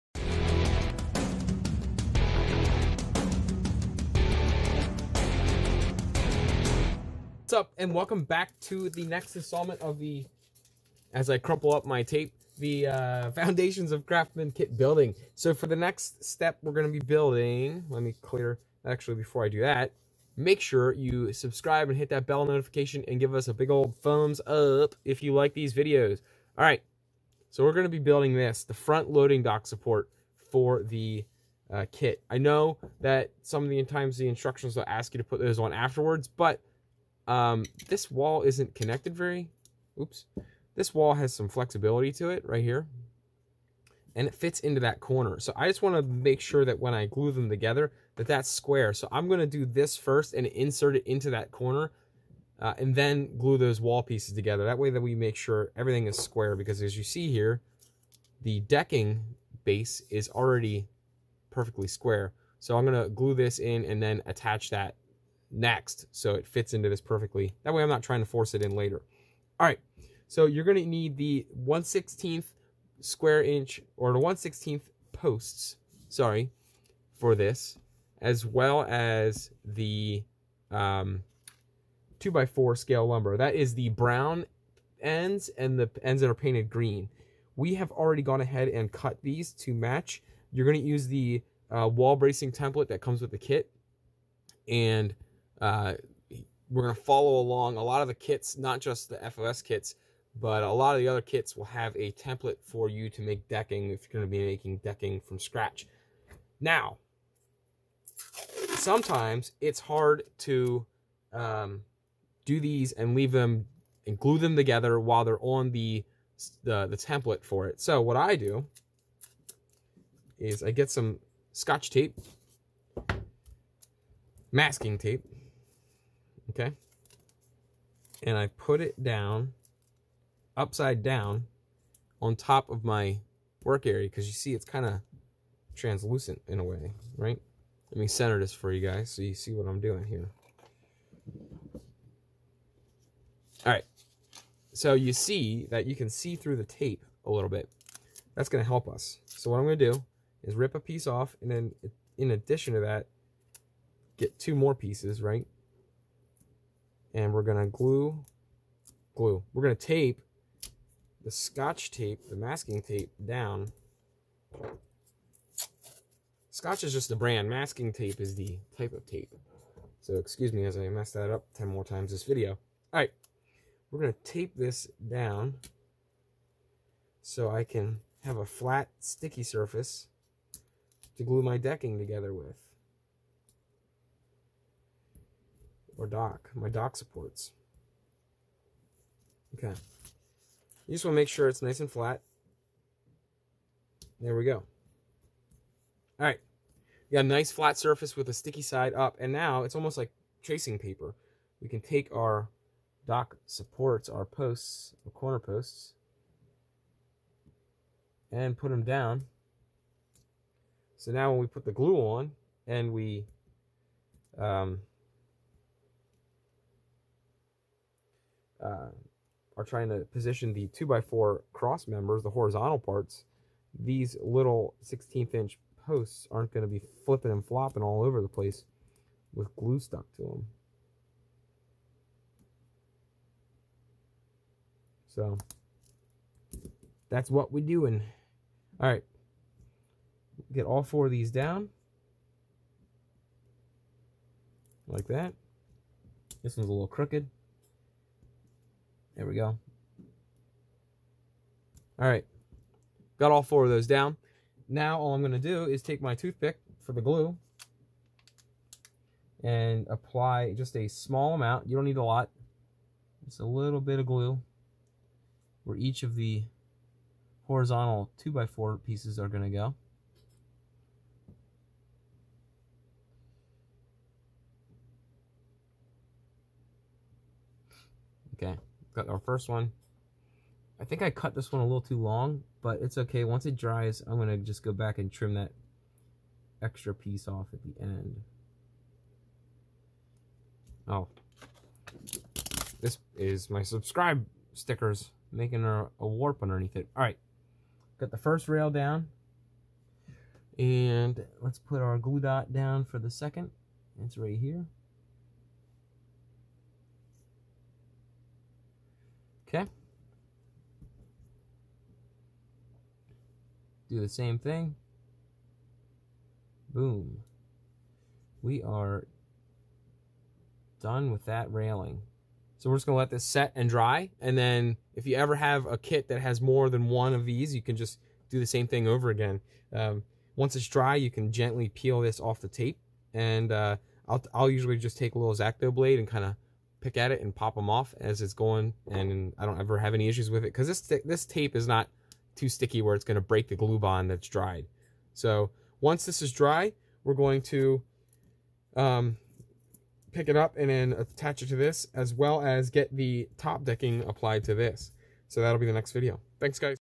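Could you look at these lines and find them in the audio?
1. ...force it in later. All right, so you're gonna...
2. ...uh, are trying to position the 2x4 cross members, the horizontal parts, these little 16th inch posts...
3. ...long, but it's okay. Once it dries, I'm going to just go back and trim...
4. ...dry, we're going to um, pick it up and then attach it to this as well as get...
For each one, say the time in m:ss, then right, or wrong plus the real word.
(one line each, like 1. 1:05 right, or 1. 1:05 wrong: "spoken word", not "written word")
1. 1:08 right
2. 3:38 right
3. 4:41 right
4. 5:46 right.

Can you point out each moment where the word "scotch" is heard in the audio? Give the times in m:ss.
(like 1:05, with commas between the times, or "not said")
2:01, 2:41, 2:46.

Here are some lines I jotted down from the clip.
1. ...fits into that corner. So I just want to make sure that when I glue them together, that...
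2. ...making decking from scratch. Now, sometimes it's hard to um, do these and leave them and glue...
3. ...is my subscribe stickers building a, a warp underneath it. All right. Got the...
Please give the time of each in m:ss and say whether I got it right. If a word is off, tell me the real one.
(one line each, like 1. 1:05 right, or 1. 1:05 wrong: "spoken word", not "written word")
1. 0:44 right
2. 1:44 right
3. 4:53 wrong: "making", not "building".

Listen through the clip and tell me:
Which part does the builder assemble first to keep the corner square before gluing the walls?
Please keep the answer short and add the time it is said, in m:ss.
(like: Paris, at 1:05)
front loading dock support, at 0:28.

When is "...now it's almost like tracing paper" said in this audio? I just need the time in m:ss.
3:19.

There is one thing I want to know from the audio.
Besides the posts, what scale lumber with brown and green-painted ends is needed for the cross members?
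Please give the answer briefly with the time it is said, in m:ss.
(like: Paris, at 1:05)
2 by 4, at 1:22.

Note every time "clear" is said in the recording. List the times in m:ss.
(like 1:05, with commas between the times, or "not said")
0:18.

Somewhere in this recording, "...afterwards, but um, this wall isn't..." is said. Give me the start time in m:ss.
0:35.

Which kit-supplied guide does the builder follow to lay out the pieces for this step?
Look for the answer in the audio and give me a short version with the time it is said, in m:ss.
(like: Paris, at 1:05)
wall bracing template, at 1:31.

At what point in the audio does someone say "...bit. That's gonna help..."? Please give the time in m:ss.
2:27.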